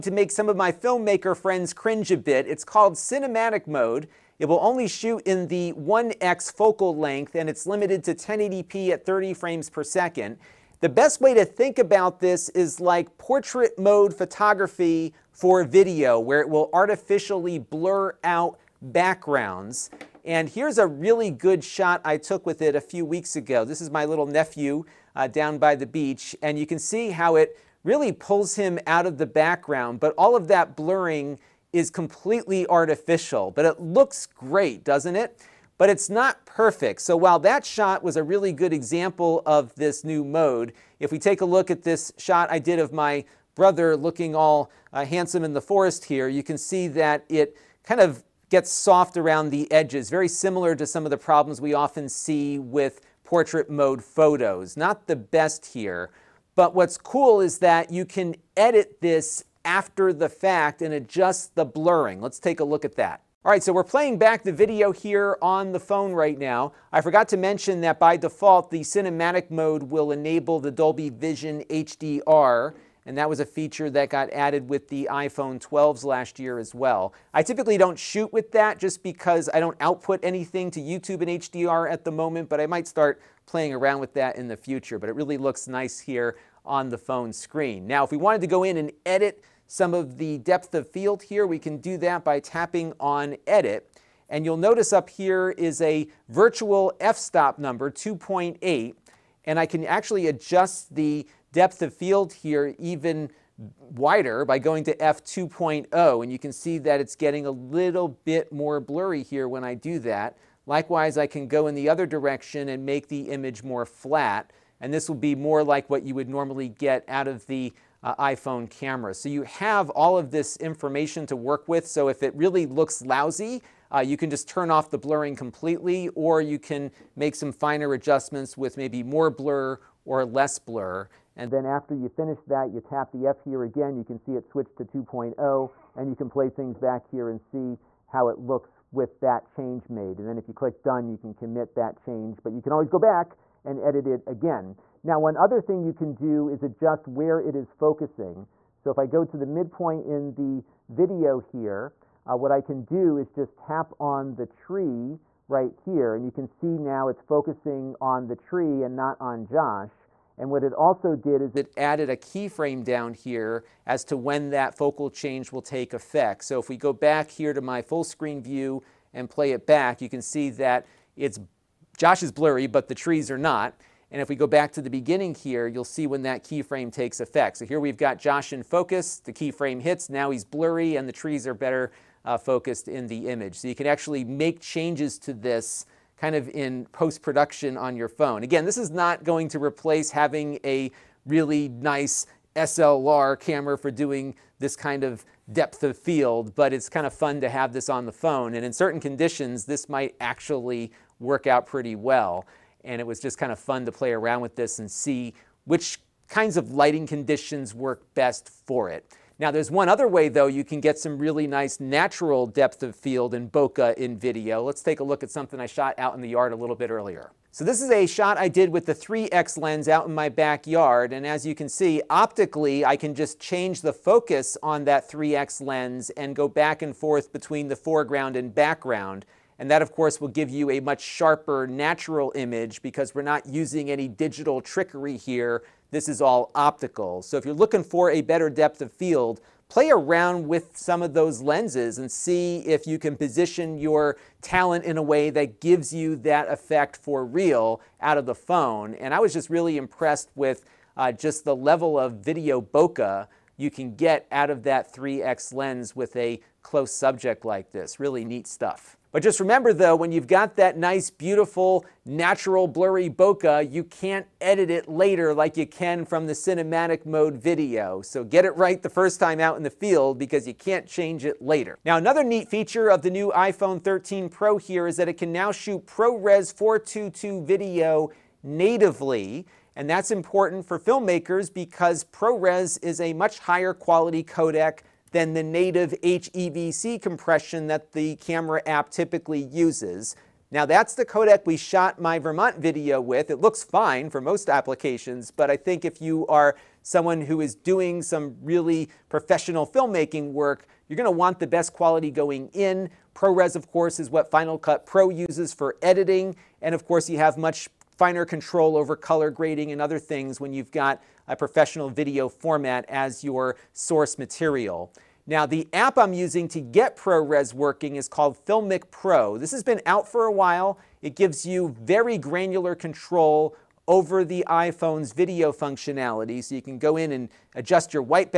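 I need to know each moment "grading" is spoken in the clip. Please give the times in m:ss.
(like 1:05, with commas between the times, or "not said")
5:09.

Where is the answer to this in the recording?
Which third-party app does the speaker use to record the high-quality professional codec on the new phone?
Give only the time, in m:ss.
5:18.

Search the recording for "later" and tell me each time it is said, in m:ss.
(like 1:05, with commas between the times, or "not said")
4:24, 4:31.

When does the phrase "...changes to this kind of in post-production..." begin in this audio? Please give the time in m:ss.
3:04.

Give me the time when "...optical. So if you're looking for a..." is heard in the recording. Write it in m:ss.
3:56.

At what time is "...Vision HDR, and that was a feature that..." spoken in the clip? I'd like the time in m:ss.
1:11.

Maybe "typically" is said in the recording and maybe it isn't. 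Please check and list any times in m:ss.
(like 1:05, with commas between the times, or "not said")
1:17, 4:48.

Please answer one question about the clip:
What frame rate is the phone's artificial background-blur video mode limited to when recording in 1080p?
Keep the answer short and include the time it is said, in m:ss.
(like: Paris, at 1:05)
30 frames per second, at 0:09.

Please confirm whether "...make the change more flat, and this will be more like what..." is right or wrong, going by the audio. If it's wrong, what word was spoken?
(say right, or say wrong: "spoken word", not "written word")
wrong: "image", not "change".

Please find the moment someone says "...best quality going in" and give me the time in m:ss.
5:01.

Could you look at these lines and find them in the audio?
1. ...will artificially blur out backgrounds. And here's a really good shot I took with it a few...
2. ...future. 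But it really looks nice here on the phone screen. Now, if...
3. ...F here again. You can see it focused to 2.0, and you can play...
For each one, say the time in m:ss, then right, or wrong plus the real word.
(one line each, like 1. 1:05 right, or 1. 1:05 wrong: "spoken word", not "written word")
1. 0:16 right
2. 1:24 right
3. 2:13 wrong: "switched", not "focused".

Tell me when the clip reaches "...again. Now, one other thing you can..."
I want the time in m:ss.
2:24.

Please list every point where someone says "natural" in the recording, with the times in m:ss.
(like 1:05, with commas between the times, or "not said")
3:31, 3:51, 4:22.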